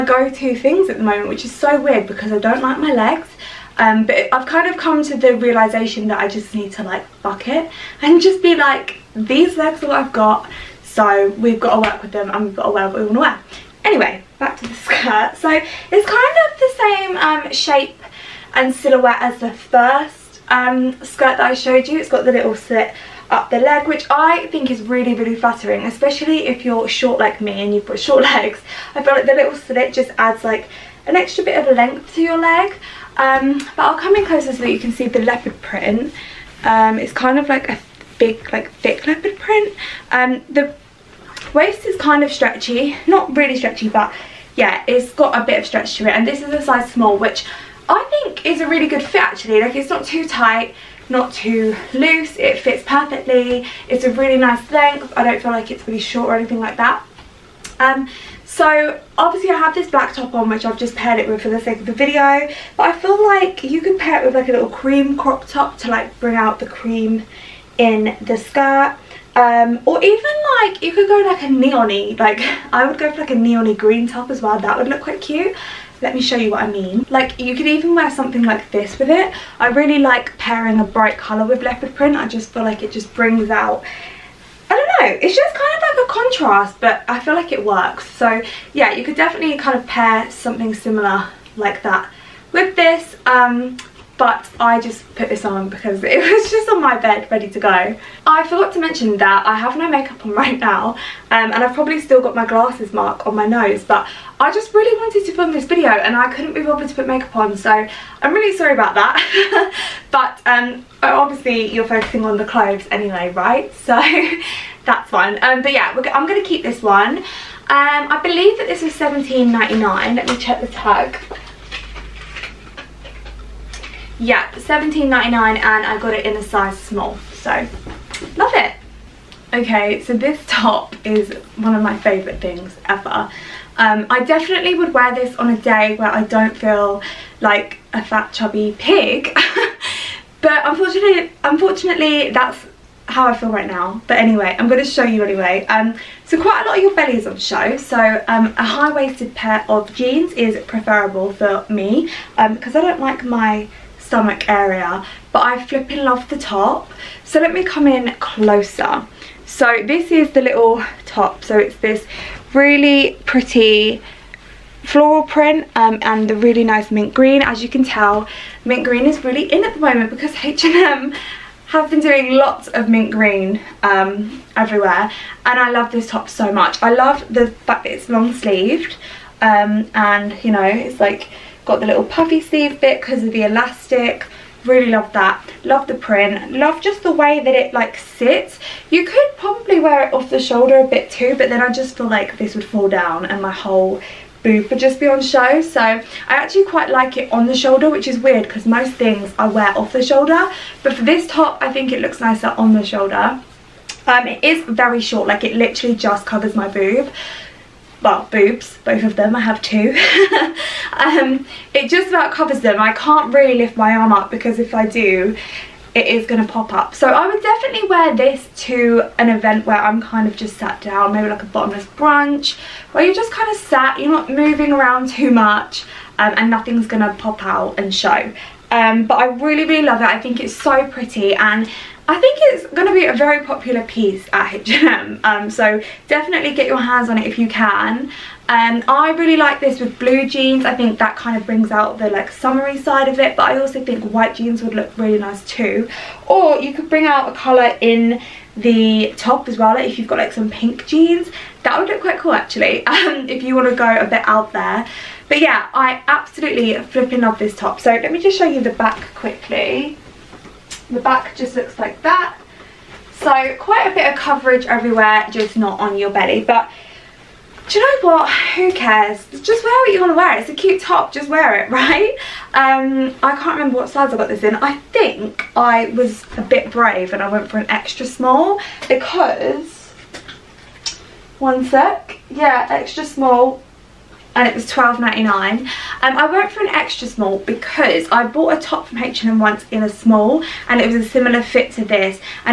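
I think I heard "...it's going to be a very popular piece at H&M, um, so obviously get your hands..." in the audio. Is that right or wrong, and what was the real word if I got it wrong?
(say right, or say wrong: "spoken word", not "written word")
wrong: "definitely", not "obviously".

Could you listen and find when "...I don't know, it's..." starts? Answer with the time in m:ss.
1:24.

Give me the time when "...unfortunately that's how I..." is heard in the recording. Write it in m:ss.
2:21.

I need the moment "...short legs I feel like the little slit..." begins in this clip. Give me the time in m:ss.
0:28.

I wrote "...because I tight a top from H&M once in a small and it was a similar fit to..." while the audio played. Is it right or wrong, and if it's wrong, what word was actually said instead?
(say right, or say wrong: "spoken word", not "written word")
wrong: "bought", not "tight".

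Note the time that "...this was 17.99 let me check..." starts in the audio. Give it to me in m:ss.
1:58.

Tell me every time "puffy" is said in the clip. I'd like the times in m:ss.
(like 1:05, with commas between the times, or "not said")
3:02.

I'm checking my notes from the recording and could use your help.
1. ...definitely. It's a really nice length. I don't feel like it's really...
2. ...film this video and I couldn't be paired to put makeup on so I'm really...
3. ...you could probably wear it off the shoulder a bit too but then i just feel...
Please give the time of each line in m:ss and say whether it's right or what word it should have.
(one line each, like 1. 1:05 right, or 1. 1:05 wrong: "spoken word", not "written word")
1. 0:52 wrong: "perfectly", not "definitely"
2. 1:45 wrong: "bothered", not "paired"
3. 3:08 right.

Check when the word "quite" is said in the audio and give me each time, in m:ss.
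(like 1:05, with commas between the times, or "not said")
1:15, 2:26, 3:16, 4:12, 4:23.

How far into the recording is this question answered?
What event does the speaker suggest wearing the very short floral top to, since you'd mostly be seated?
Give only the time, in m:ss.
3:41.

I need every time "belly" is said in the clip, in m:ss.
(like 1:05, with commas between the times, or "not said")
2:26, 4:26.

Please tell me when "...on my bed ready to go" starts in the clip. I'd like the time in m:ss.
1:36.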